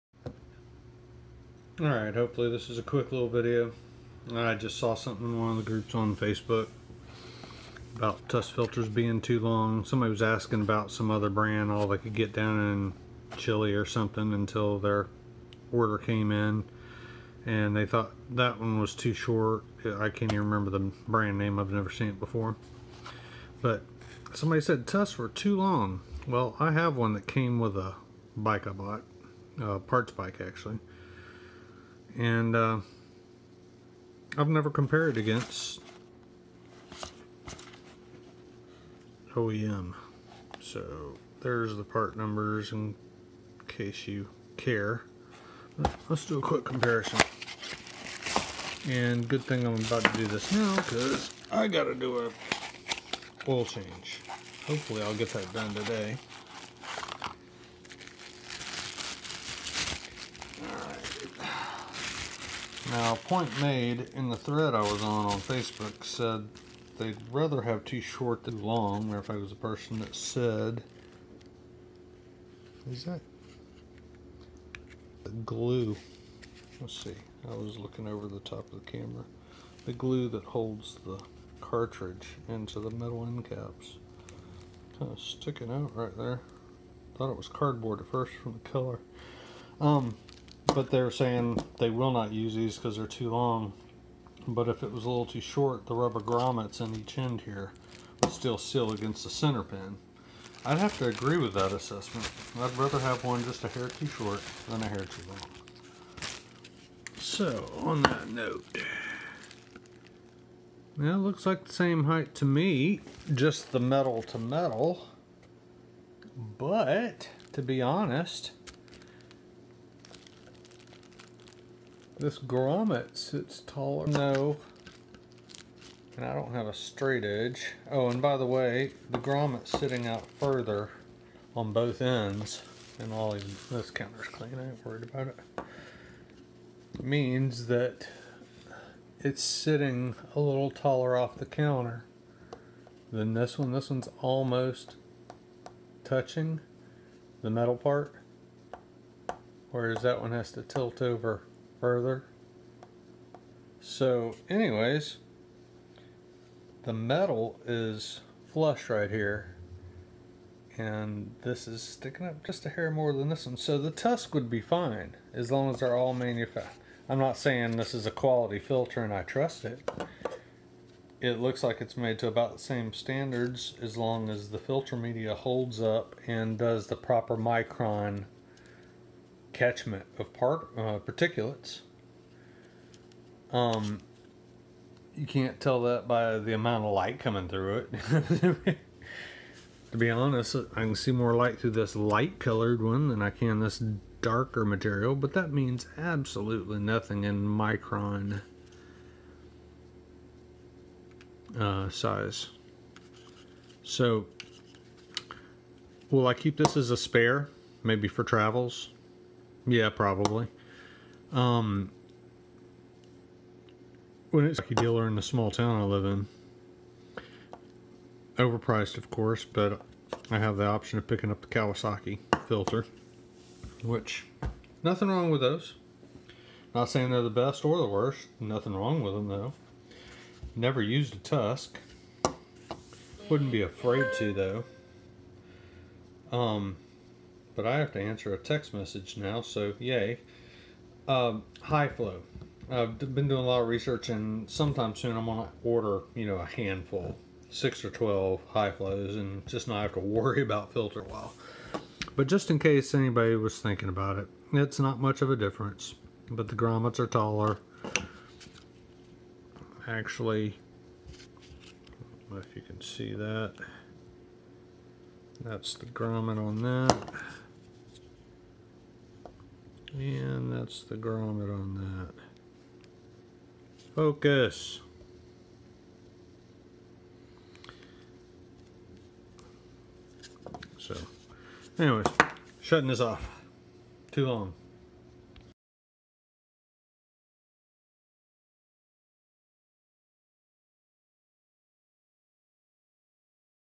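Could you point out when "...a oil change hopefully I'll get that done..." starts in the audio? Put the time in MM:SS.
00:52.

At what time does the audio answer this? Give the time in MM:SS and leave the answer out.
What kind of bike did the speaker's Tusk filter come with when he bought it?
00:29.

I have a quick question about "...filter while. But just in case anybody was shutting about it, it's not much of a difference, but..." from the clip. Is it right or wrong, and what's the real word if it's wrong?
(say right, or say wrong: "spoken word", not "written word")
wrong: "thinking", not "shutting".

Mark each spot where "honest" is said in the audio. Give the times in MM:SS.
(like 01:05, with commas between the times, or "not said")
01:57, 03:10.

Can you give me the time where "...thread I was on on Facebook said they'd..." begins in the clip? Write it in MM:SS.
01:04.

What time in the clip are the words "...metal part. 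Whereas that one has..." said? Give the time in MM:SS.
02:27.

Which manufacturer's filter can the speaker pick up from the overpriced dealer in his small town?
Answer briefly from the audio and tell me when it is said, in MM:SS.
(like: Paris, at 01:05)
Kawasaki, at 03:41.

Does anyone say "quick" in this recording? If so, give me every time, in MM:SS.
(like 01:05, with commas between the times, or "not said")
00:02, 00:46.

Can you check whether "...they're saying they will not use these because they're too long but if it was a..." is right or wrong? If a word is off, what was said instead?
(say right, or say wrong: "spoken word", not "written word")
right.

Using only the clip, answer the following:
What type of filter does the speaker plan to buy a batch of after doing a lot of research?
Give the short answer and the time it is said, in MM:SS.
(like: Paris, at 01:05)
high flow, at 04:01.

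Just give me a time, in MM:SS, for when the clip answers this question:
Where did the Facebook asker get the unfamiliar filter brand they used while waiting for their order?
00:13.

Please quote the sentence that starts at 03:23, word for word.
So, will I keep this as a spare, maybe for travels?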